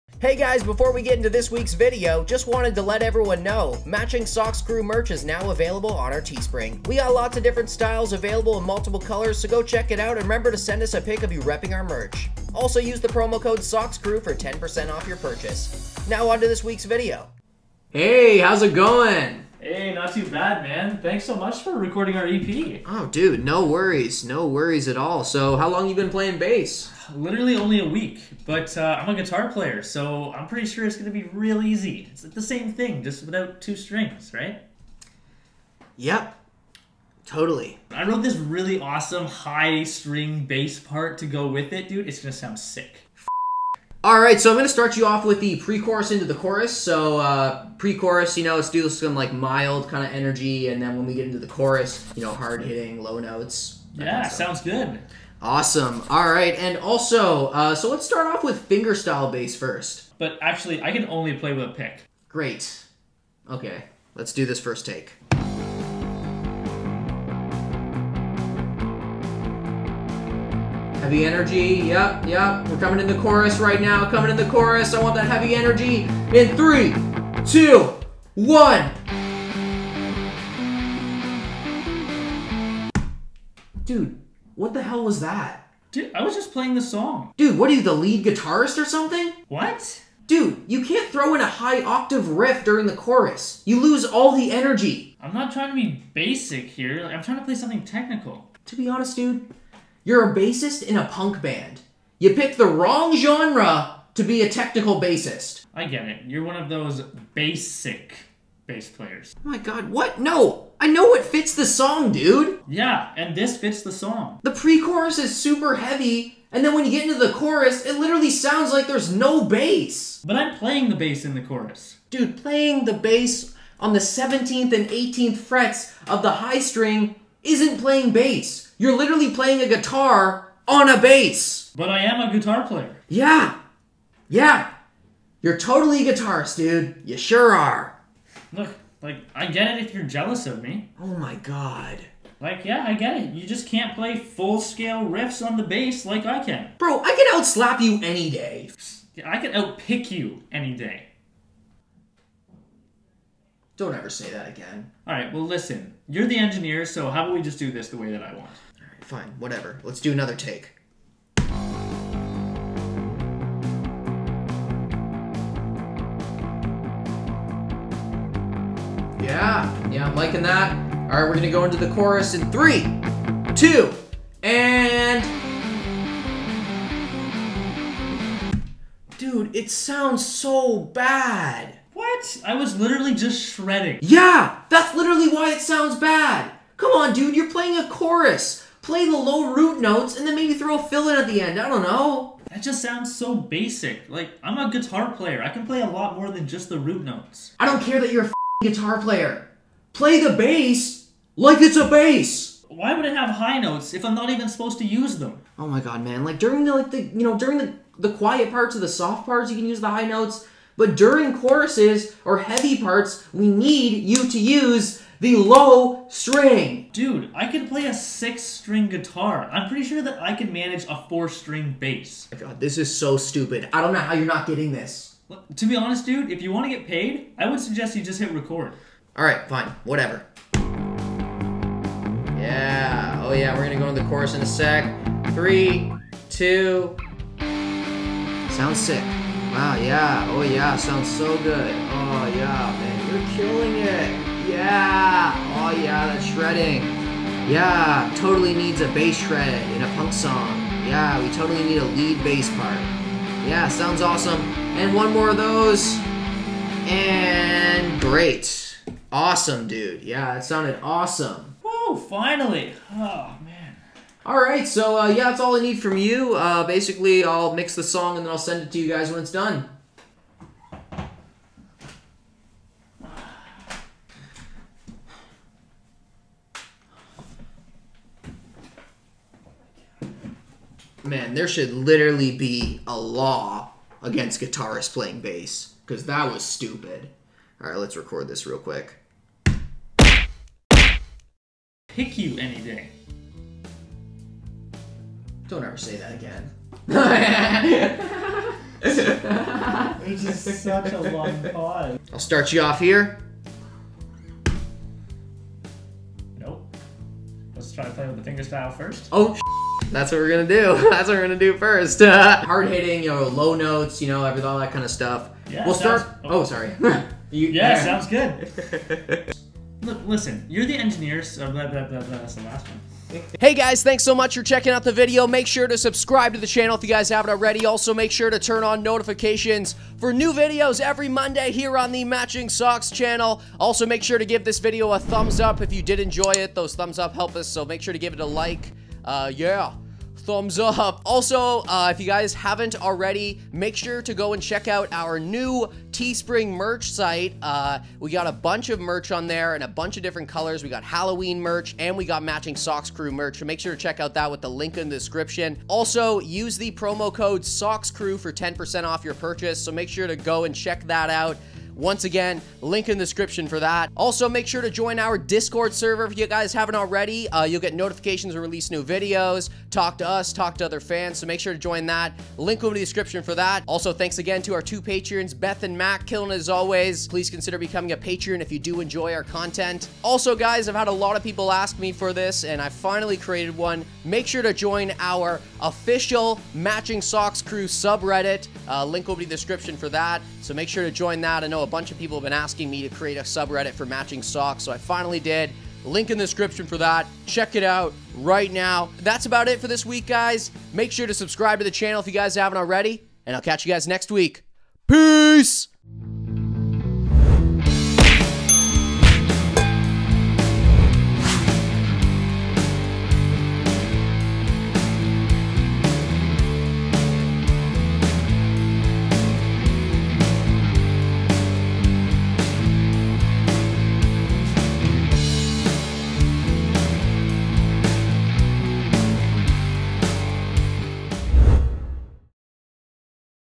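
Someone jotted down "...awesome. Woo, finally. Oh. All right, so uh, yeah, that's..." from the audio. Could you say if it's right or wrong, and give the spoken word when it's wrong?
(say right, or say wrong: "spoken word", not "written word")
right.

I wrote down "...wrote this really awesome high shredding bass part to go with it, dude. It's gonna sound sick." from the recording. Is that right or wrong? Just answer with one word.
wrong.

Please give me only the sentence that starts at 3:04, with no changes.
Yeah, that's literally why it sounds bad.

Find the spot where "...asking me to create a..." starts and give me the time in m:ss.
6:32.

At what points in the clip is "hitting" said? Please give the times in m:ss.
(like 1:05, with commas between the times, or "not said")
0:52, 5:12.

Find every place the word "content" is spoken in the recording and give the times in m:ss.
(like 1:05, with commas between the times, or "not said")
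6:19.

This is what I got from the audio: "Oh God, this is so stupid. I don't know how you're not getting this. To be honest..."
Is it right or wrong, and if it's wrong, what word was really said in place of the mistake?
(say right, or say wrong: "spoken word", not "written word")
right.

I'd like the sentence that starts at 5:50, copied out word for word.
We got Halloween merch and we got matching Sox Crew merch.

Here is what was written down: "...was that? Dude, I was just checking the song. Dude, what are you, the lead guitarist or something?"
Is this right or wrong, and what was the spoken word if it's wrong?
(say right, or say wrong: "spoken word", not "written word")
wrong: "playing", not "checking".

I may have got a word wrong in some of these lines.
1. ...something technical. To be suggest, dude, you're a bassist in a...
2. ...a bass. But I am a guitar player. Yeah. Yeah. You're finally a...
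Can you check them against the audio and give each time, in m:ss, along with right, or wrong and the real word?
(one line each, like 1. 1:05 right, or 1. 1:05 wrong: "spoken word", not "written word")
1. 1:37 wrong: "honest", not "suggest"
2. 2:10 wrong: "totally", not "finally".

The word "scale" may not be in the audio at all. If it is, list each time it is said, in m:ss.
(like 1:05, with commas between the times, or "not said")
2:24.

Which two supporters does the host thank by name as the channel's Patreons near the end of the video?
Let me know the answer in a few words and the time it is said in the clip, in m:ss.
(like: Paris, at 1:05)
Beth and Mac, at 6:15.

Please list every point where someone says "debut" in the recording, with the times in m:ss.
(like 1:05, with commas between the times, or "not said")
not said.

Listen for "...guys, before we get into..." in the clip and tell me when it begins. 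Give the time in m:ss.
0:00.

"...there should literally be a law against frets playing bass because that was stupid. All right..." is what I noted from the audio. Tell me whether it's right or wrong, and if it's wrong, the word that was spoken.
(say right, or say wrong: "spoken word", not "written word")
wrong: "guitarists", not "frets".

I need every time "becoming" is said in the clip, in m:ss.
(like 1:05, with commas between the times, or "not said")
6:17.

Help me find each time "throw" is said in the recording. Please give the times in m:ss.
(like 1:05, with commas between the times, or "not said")
1:31, 3:10.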